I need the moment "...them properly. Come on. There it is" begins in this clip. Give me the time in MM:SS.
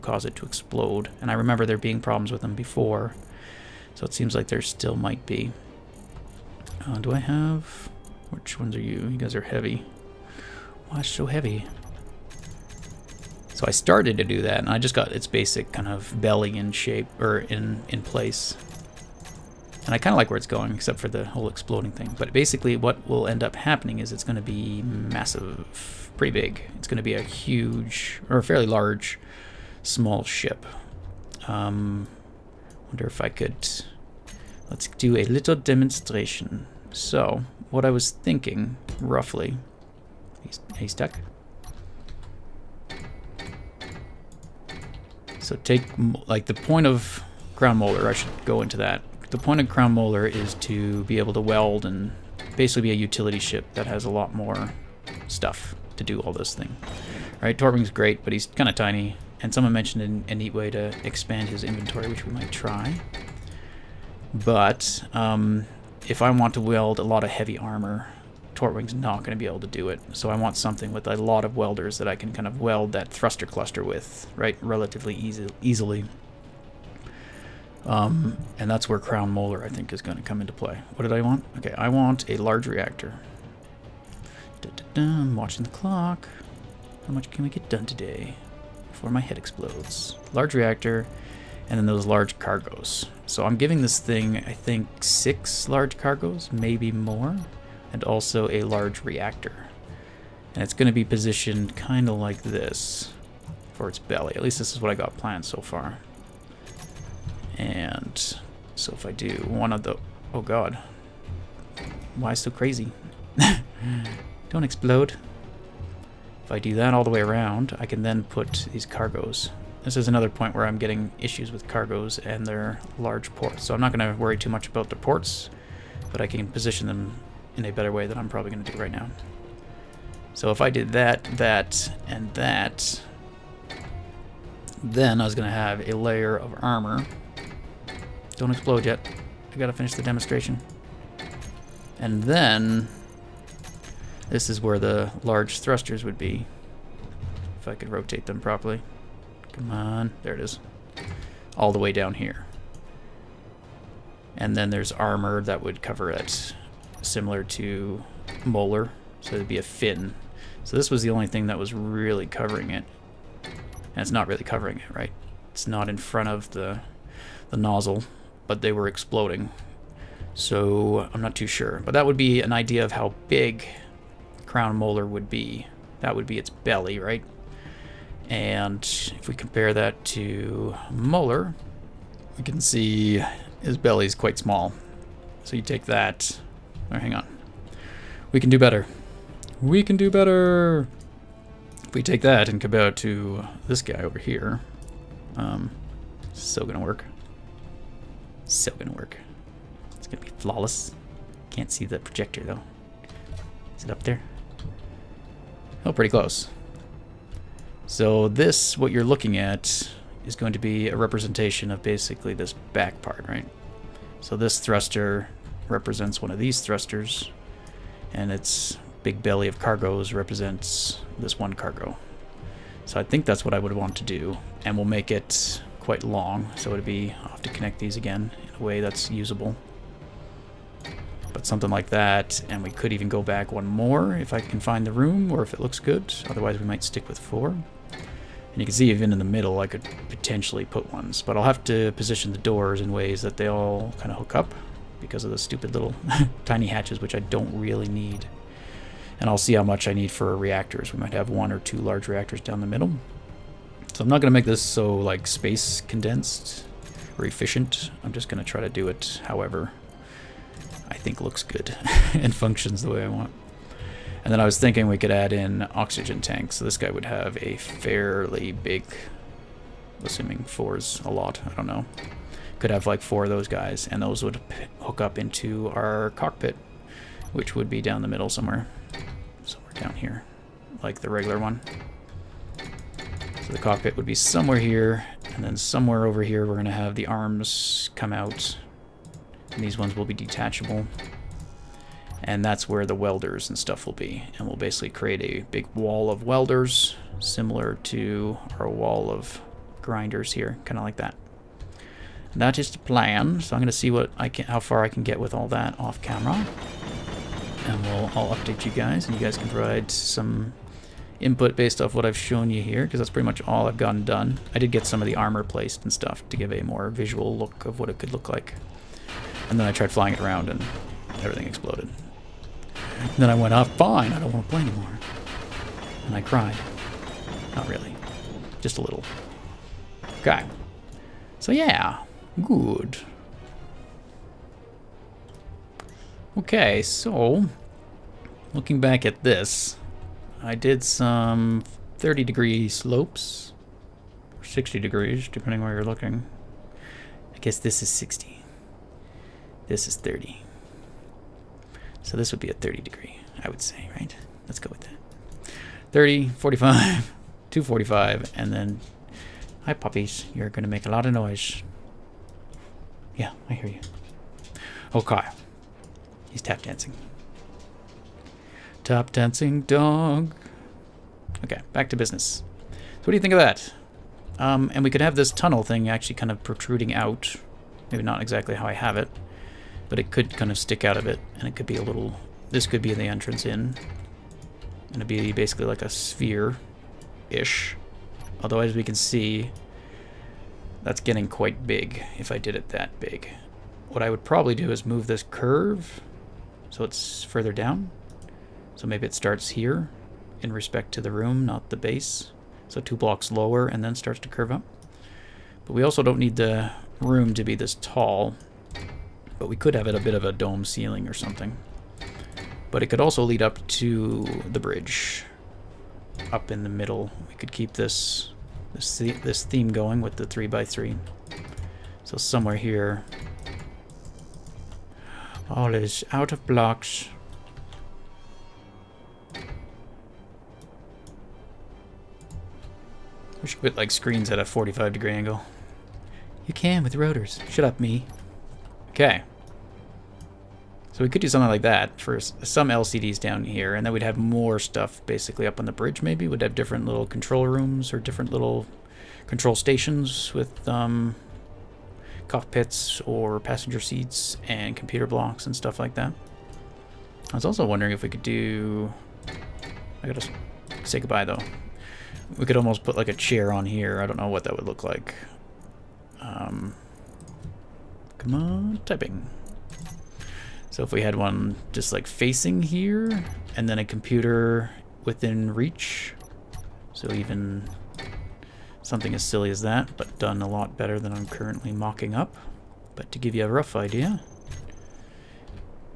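02:28.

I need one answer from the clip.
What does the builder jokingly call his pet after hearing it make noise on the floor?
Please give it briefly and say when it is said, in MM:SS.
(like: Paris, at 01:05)
Tap dancing dog, at 06:08.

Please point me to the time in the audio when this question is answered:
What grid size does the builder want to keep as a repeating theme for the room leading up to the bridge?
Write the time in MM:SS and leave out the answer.
07:00.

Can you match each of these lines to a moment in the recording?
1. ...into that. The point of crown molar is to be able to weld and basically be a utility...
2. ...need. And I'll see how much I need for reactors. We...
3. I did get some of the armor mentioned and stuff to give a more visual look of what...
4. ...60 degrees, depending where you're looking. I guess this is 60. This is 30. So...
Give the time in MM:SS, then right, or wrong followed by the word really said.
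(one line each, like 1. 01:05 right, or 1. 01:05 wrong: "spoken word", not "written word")
1. 00:48 right
2. 04:07 right
3. 05:14 wrong: "placed", not "mentioned"
4. 05:44 right.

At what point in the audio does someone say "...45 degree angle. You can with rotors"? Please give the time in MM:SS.
07:14.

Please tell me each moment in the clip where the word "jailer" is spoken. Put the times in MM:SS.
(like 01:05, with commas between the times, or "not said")
not said.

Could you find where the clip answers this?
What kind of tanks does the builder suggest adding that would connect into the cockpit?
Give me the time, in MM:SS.
04:25.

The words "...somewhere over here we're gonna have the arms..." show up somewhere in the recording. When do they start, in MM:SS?
04:45.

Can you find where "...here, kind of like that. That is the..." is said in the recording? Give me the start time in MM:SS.
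05:00.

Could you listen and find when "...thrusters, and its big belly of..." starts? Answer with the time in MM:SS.
03:36.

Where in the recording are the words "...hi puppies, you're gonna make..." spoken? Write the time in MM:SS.
05:59.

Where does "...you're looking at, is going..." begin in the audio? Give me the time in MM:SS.
03:28.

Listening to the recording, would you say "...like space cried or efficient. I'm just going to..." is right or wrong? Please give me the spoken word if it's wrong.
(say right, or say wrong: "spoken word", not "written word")
wrong: "condensed", not "cried".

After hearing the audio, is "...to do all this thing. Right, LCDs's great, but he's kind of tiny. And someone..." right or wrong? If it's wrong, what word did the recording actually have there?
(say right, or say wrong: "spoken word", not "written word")
wrong: "Tortwing", not "LCDs".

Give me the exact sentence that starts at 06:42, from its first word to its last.
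So two blocks lower and then starts to curve up.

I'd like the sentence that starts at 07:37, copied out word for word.
I was also wondering if we could do...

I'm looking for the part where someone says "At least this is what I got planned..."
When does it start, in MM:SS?
01:44.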